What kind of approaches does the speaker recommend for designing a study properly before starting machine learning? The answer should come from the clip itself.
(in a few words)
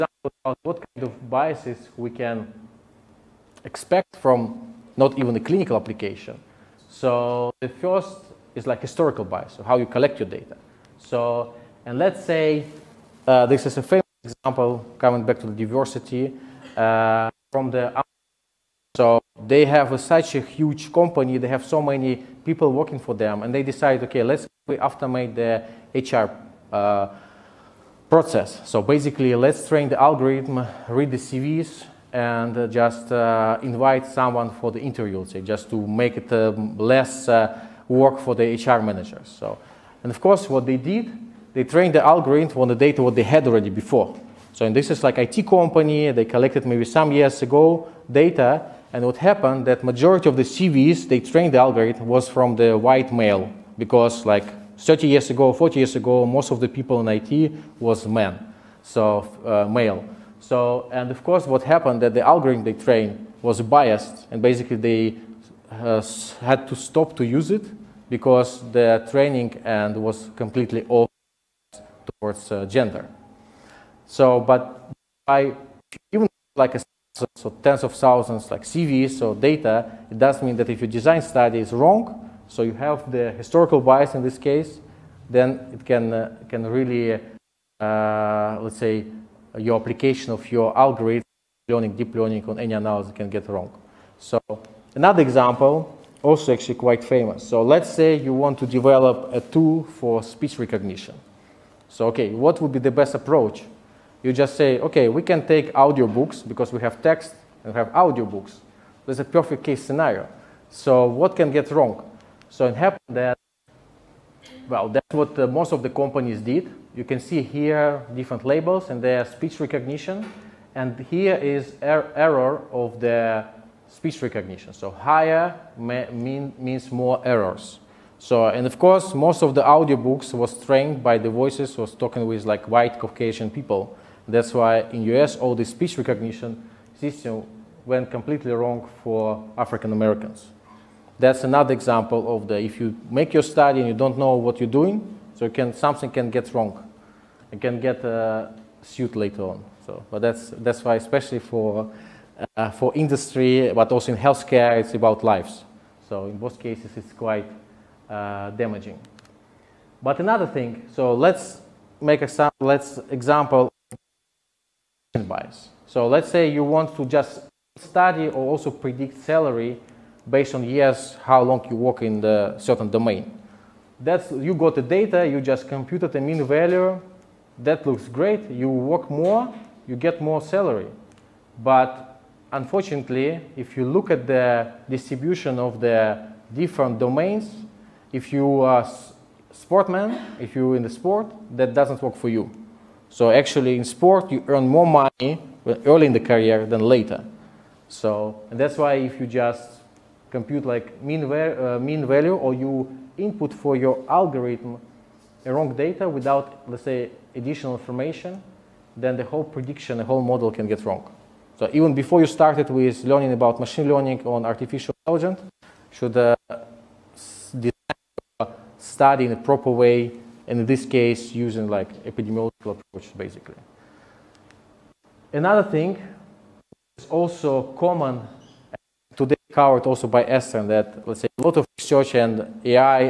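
Epidemiological approaches.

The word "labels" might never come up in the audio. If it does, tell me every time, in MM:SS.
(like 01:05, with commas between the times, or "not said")
01:58.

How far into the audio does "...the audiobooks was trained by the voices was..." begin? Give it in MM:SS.
02:09.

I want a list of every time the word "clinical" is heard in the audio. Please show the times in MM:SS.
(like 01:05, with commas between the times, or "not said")
00:05.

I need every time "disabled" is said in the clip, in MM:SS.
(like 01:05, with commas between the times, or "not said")
not said.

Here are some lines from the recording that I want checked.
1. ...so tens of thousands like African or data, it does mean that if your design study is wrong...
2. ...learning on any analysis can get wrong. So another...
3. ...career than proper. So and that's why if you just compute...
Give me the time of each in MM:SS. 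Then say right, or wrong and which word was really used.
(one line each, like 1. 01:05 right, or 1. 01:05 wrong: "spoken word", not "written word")
1. 01:17 wrong: "CVs", not "African"
2. 01:32 right
3. 03:16 wrong: "later", not "proper".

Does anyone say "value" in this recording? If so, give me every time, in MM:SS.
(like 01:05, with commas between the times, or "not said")
02:56, 03:22.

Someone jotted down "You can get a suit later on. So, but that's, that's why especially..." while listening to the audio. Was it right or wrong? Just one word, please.
right.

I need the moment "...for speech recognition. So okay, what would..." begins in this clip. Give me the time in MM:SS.
01:39.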